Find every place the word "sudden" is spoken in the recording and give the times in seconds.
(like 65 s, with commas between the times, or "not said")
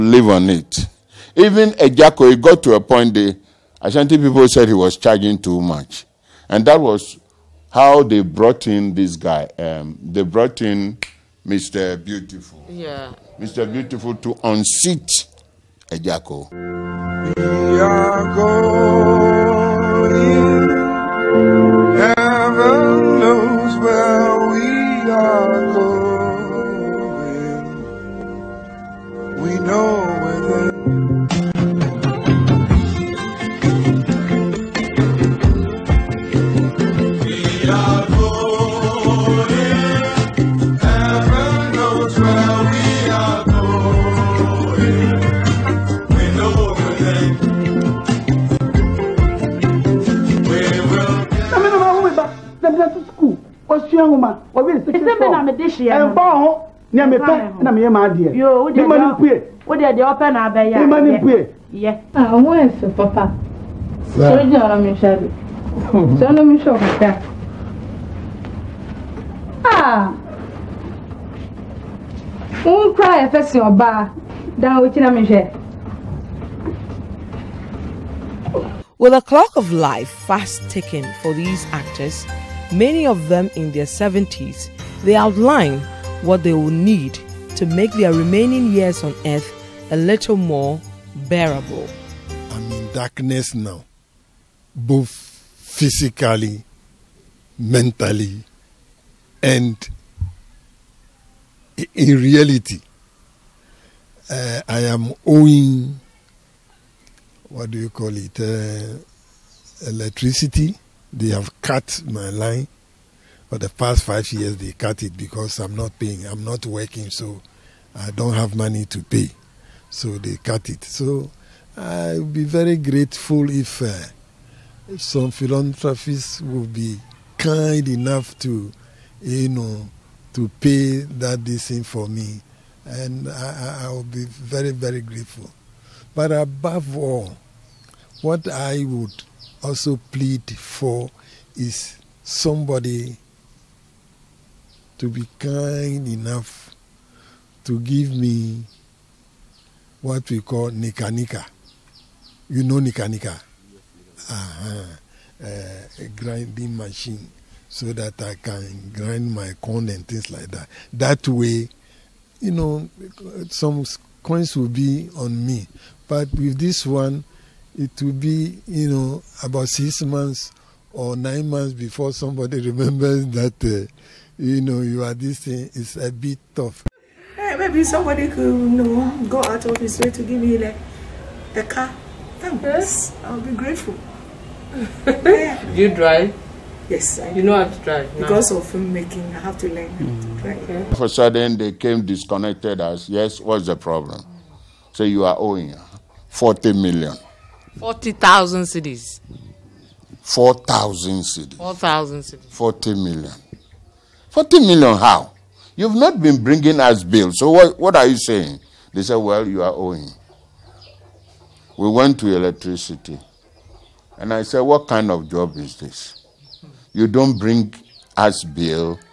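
191 s.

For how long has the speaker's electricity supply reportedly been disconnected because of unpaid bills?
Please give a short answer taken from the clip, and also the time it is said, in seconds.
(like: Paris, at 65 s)
5 years, at 114 s.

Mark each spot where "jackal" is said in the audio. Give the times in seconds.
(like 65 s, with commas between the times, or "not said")
1 s.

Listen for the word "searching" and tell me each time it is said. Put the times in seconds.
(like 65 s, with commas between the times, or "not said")
not said.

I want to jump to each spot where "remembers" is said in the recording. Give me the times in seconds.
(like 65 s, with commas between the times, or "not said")
172 s.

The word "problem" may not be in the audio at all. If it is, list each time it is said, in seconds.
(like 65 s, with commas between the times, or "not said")
193 s.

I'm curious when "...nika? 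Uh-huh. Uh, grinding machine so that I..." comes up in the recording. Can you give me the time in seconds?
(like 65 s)
153 s.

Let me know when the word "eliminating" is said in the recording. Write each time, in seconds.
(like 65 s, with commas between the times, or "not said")
not said.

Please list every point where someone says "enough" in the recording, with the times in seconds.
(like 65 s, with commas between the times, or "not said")
127 s, 146 s.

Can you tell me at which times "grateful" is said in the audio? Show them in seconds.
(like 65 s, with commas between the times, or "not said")
122 s, 134 s, 183 s.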